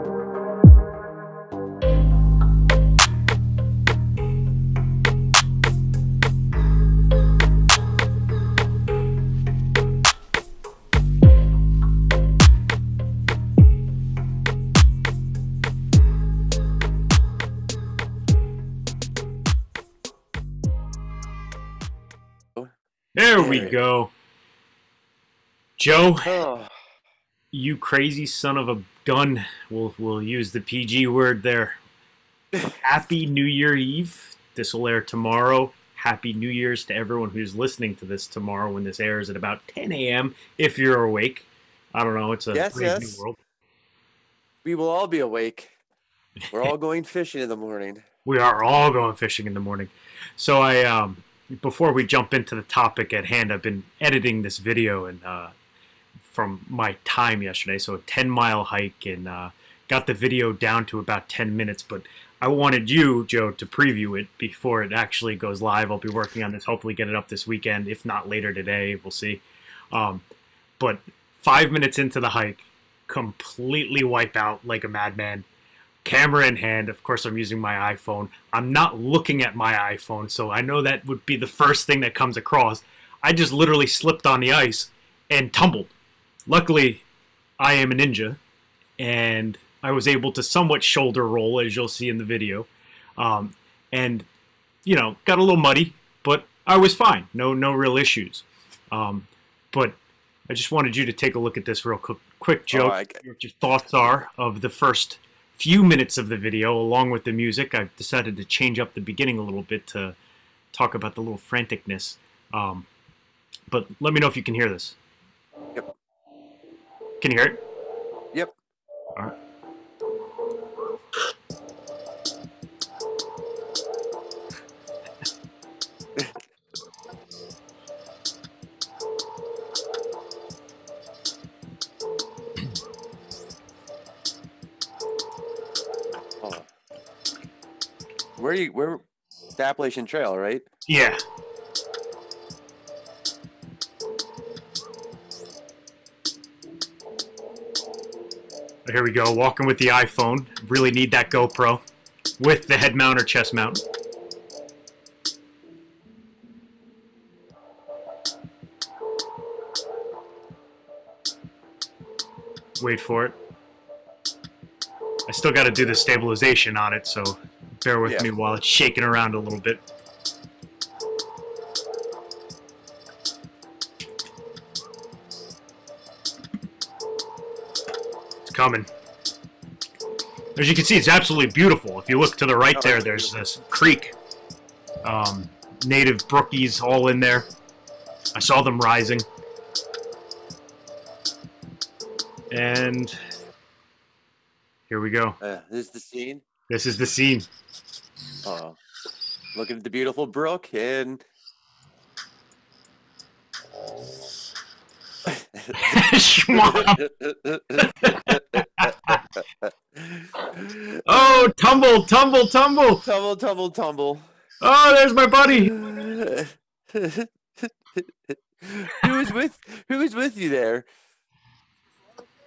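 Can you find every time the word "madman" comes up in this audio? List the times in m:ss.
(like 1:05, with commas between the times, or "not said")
1:14.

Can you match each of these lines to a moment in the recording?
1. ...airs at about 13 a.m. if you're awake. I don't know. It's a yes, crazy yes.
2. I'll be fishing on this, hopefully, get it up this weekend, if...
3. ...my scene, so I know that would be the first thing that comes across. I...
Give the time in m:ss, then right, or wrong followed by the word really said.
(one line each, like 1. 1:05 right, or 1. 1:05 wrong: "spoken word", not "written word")
1. 0:38 wrong: "10", not "13"
2. 1:05 wrong: "working", not "fishing"
3. 1:19 wrong: "iPhone", not "scene".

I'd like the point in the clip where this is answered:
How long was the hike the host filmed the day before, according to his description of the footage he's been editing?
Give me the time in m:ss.
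0:57.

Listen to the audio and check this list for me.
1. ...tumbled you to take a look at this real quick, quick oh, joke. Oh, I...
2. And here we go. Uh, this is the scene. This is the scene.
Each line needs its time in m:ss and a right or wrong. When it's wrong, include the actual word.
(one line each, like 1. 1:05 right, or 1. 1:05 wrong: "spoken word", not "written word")
1. 1:40 wrong: "wanted", not "tumbled"
2. 3:12 right.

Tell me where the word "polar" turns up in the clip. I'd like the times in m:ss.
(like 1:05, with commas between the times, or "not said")
not said.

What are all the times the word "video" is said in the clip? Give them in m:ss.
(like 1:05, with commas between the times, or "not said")
0:54, 1:00, 1:32, 1:46.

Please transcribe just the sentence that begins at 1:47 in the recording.
I've decided to change up the beginning a little bit to talk about the little franticness.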